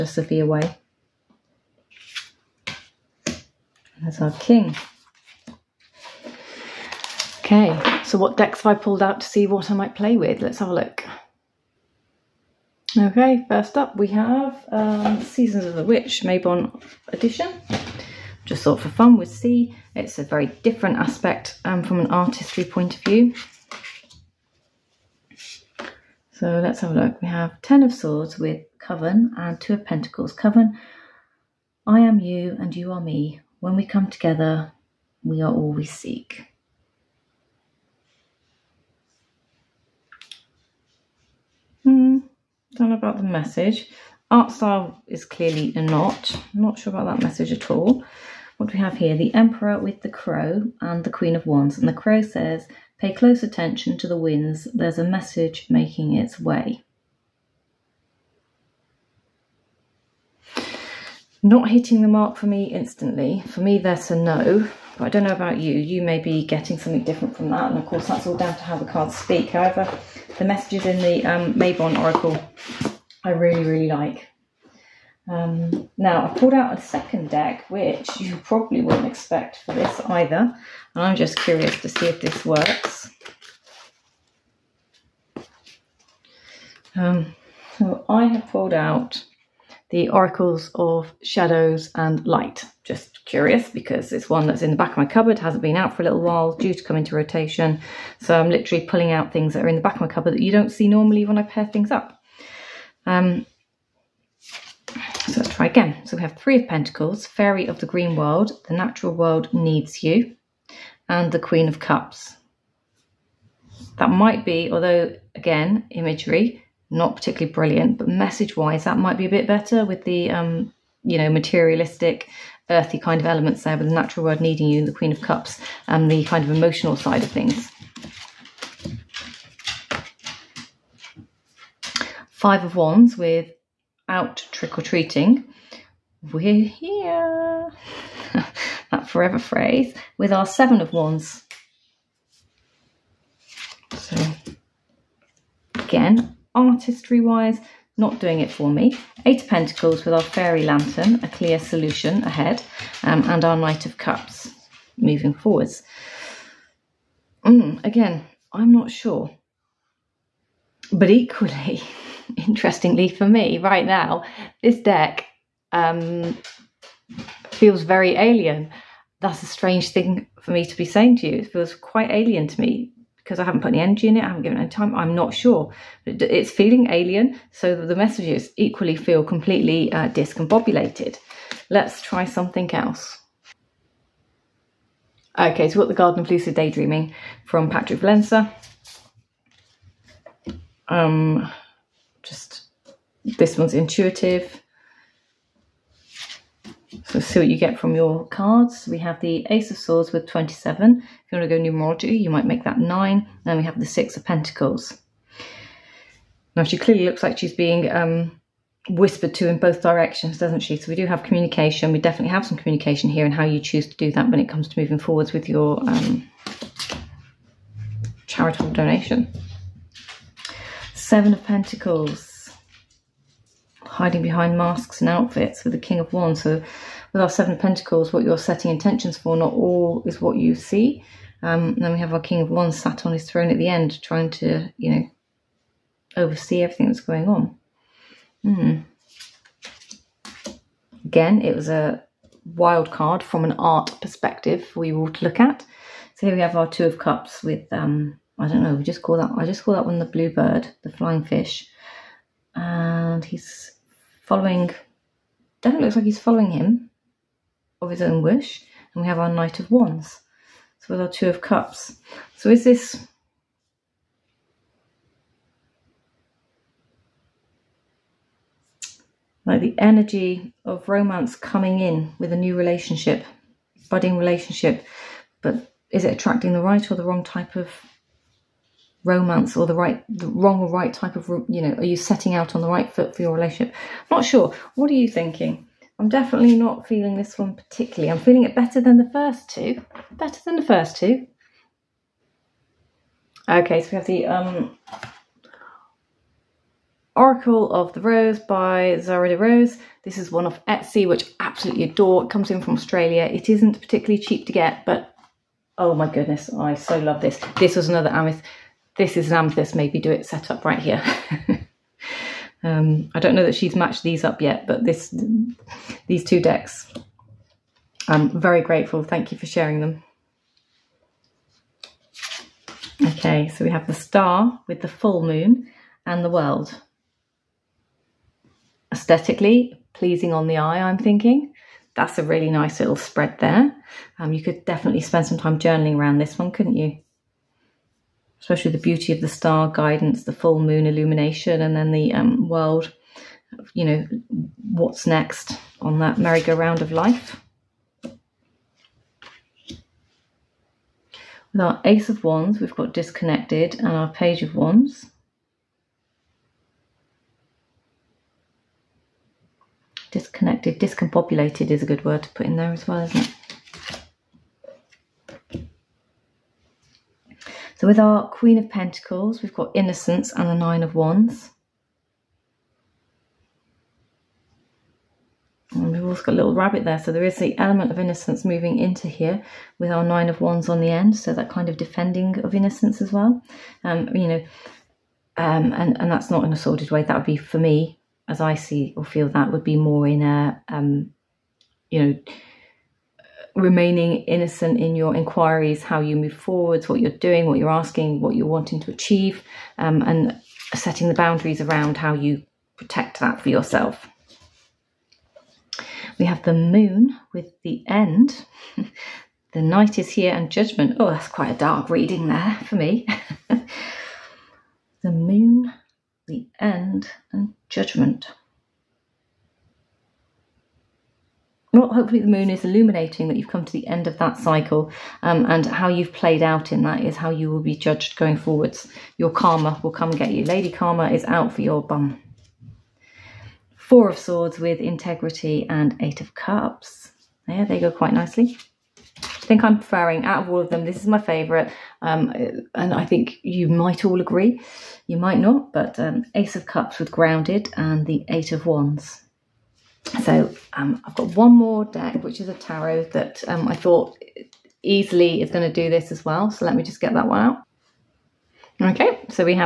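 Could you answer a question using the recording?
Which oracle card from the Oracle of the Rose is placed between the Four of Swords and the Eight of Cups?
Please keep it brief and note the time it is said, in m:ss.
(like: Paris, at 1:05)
Integrity, at 7:14.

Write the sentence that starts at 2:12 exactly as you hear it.
Five of Wands without trick or treating.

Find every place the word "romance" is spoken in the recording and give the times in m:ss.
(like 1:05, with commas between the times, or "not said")
4:30, 4:39.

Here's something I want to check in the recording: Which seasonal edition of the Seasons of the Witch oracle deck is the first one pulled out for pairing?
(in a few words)
Mabon Edition.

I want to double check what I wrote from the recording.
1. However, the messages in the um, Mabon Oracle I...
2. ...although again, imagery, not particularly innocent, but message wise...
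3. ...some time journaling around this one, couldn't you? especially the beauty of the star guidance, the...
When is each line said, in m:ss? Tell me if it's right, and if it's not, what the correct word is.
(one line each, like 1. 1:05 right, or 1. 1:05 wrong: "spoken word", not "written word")
1. 1:09 right
2. 1:54 wrong: "brilliant", not "innocent"
3. 5:35 right.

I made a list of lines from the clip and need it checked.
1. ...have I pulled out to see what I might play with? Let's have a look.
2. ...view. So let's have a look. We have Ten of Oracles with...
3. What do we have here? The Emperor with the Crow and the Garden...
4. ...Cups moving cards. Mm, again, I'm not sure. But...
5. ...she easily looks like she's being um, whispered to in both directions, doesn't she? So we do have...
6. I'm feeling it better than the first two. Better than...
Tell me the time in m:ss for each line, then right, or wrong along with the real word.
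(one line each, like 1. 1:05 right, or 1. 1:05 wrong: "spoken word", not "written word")
1. 0:08 right
2. 0:23 wrong: "Swords", not "Oracles"
3. 0:48 wrong: "Queen", not "Garden"
4. 2:33 wrong: "forwards", not "cards"
5. 3:26 wrong: "clearly", not "easily"
6. 4:48 right.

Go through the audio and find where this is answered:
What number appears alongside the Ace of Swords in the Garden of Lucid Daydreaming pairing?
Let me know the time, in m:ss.
3:20.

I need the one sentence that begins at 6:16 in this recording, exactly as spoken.
So there is the element of innocence moving into here with our Nine of Wands on the end.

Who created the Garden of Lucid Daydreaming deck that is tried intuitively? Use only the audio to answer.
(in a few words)
Patrick Valenza.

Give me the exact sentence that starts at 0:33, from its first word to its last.
When we come together, we are all we seek.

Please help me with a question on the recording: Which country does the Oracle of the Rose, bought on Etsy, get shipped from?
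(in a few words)
Australia.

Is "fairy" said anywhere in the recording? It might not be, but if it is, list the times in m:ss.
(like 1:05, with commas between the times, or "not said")
1:47, 2:30.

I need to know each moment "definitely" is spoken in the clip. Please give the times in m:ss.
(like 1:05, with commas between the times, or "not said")
3:31, 4:15, 4:46, 5:34.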